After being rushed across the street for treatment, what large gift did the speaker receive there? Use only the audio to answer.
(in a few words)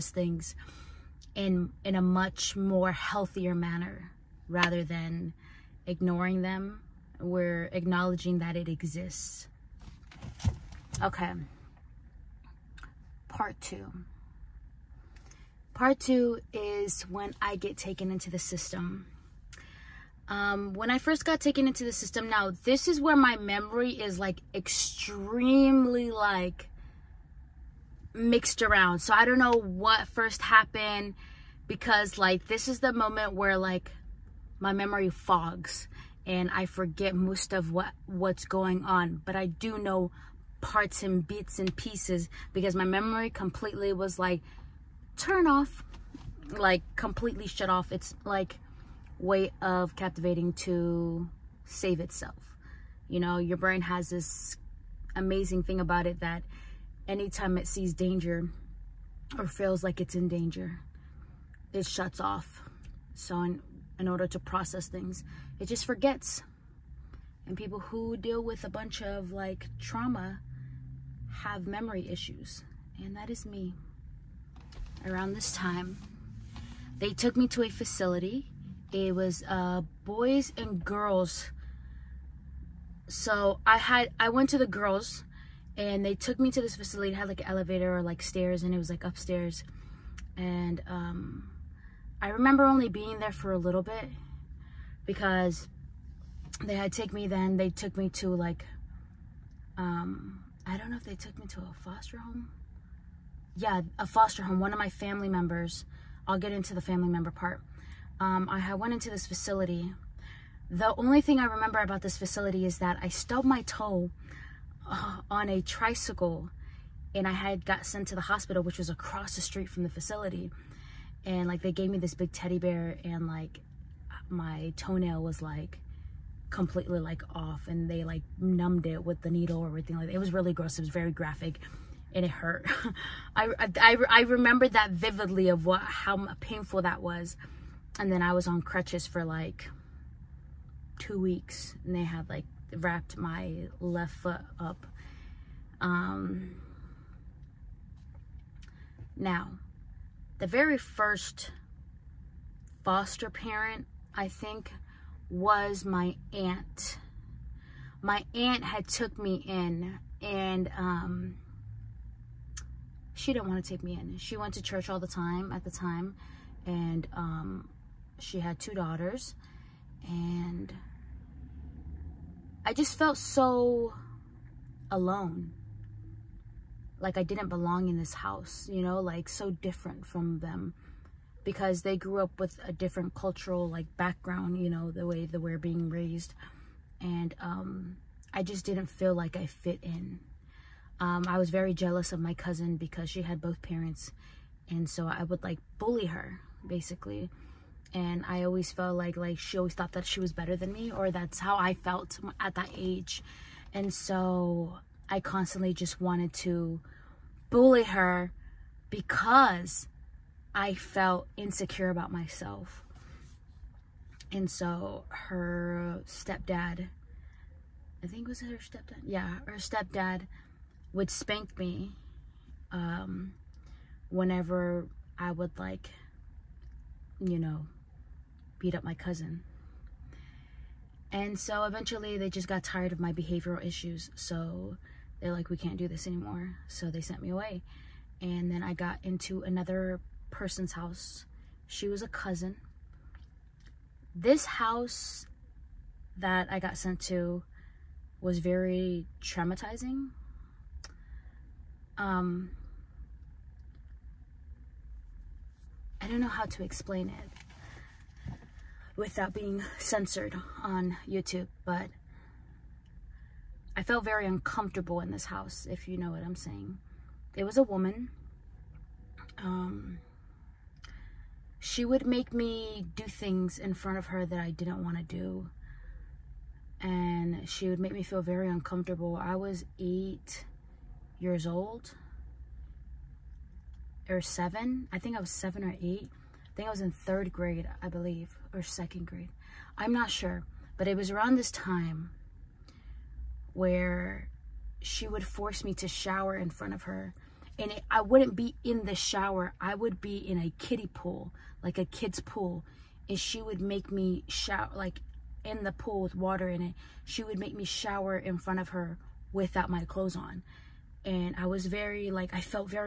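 big teddy bear.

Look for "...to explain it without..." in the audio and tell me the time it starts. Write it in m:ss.
4:16.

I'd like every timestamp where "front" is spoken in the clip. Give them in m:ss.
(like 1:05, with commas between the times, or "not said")
4:33, 4:56, 5:08.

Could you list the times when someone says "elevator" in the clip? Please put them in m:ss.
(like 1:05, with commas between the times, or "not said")
1:27.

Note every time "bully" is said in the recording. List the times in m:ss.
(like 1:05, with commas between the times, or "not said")
3:15, 3:27.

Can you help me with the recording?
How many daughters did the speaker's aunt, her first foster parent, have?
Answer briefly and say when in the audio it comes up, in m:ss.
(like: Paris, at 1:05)
2, at 2:48.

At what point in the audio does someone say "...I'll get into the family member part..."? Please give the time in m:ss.
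1:46.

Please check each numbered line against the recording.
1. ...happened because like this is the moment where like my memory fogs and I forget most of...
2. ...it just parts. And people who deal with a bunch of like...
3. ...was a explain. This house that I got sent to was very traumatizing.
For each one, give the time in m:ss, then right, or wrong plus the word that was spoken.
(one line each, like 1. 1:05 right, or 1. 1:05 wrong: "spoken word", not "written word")
1. 0:30 right
2. 1:05 wrong: "forgets", not "parts"
3. 4:01 wrong: "cousin", not "explain".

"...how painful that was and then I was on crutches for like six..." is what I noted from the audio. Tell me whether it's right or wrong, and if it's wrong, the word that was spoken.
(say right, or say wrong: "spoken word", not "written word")
wrong: "two", not "six".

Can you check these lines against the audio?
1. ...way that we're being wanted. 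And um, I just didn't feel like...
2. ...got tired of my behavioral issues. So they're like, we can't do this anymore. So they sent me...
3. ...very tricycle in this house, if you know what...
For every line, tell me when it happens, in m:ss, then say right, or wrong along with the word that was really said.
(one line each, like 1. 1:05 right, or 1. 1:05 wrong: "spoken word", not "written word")
1. 3:05 wrong: "raised", not "wanted"
2. 3:52 right
3. 4:24 wrong: "uncomfortable", not "tricycle".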